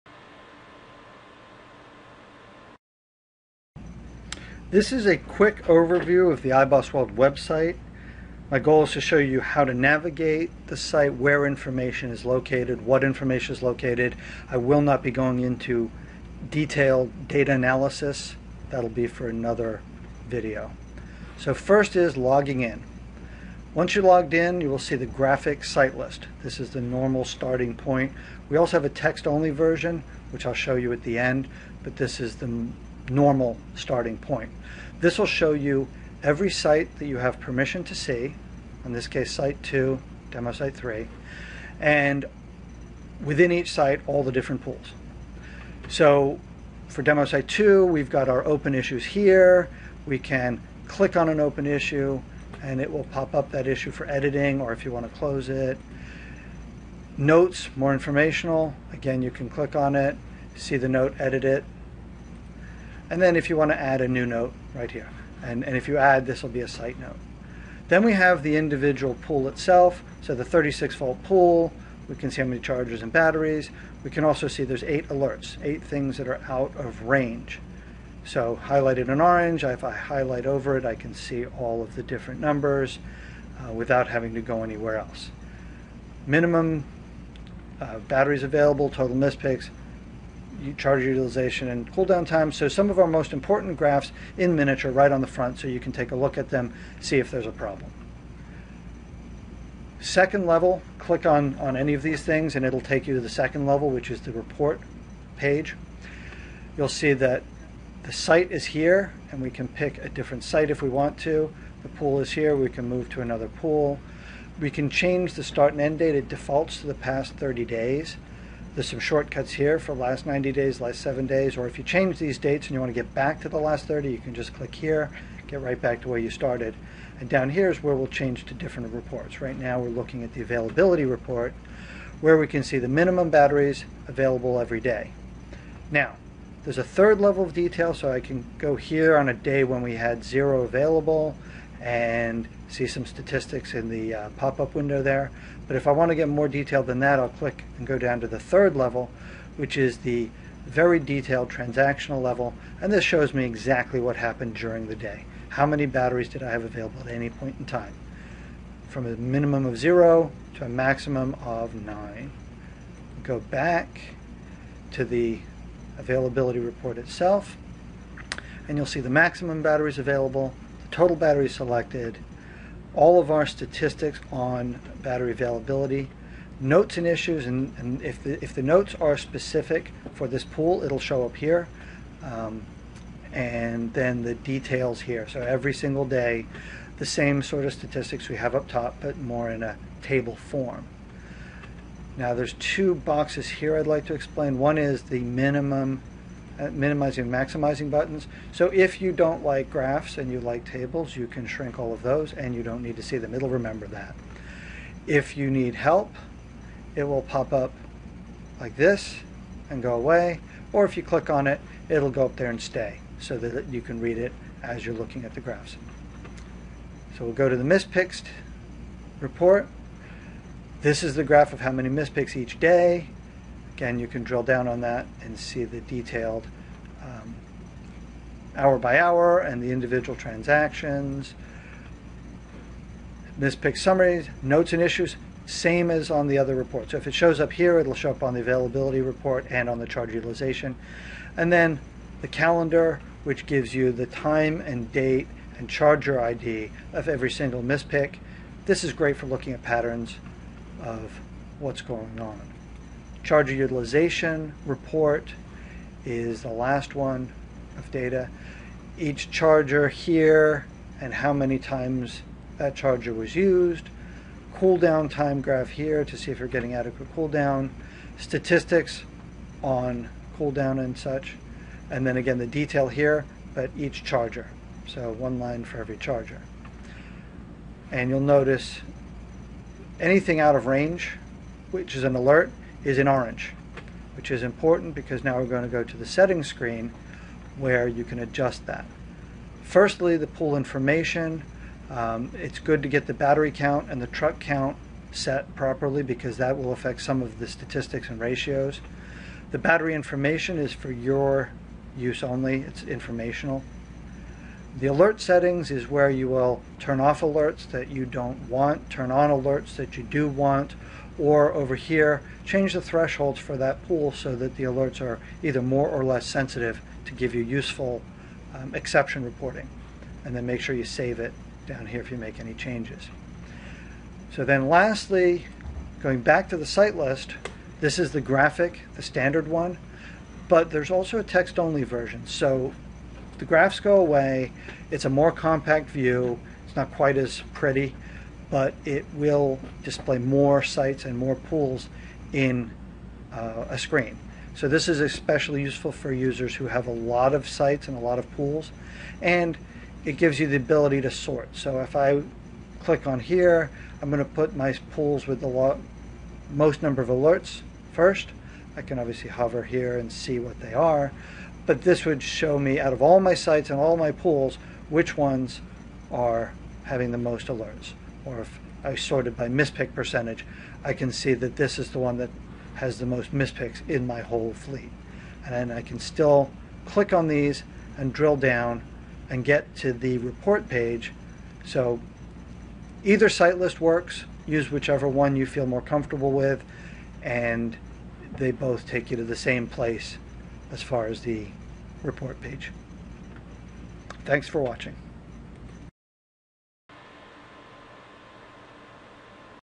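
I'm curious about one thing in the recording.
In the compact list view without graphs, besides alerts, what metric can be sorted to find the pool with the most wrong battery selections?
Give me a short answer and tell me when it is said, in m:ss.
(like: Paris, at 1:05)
mispick percentage, at 6:09.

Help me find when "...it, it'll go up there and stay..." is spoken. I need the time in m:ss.
3:31.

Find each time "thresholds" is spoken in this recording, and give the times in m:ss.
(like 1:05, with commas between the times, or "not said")
5:12.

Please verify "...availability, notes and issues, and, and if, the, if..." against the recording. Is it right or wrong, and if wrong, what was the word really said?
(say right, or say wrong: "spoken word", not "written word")
right.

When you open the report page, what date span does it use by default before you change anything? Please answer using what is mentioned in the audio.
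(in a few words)
past 30 days.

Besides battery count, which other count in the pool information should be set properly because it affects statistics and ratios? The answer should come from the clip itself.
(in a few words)
truck count.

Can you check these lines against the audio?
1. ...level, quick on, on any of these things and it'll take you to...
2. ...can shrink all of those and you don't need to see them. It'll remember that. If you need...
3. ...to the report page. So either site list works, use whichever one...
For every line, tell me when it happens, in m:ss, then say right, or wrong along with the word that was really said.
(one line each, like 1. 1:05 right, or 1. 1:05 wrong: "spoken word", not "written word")
1. 1:40 wrong: "click", not "quick"
2. 3:21 right
3. 6:19 right.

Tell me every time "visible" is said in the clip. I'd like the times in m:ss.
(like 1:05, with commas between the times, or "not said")
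not said.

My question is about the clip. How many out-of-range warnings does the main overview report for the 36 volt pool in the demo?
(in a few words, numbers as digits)
8.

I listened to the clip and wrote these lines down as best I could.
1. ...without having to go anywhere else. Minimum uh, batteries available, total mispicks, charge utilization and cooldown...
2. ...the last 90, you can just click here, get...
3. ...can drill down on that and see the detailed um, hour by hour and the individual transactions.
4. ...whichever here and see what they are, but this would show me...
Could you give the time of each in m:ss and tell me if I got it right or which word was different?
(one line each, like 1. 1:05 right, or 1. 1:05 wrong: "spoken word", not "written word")
1. 1:23 right
2. 2:03 wrong: "30", not "90"
3. 3:44 right
4. 5:59 wrong: "hover", not "whichever".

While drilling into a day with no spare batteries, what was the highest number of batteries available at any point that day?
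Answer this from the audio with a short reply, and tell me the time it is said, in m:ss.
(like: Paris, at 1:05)
9, at 2:41.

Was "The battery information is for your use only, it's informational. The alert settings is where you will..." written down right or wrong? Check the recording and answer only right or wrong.
right.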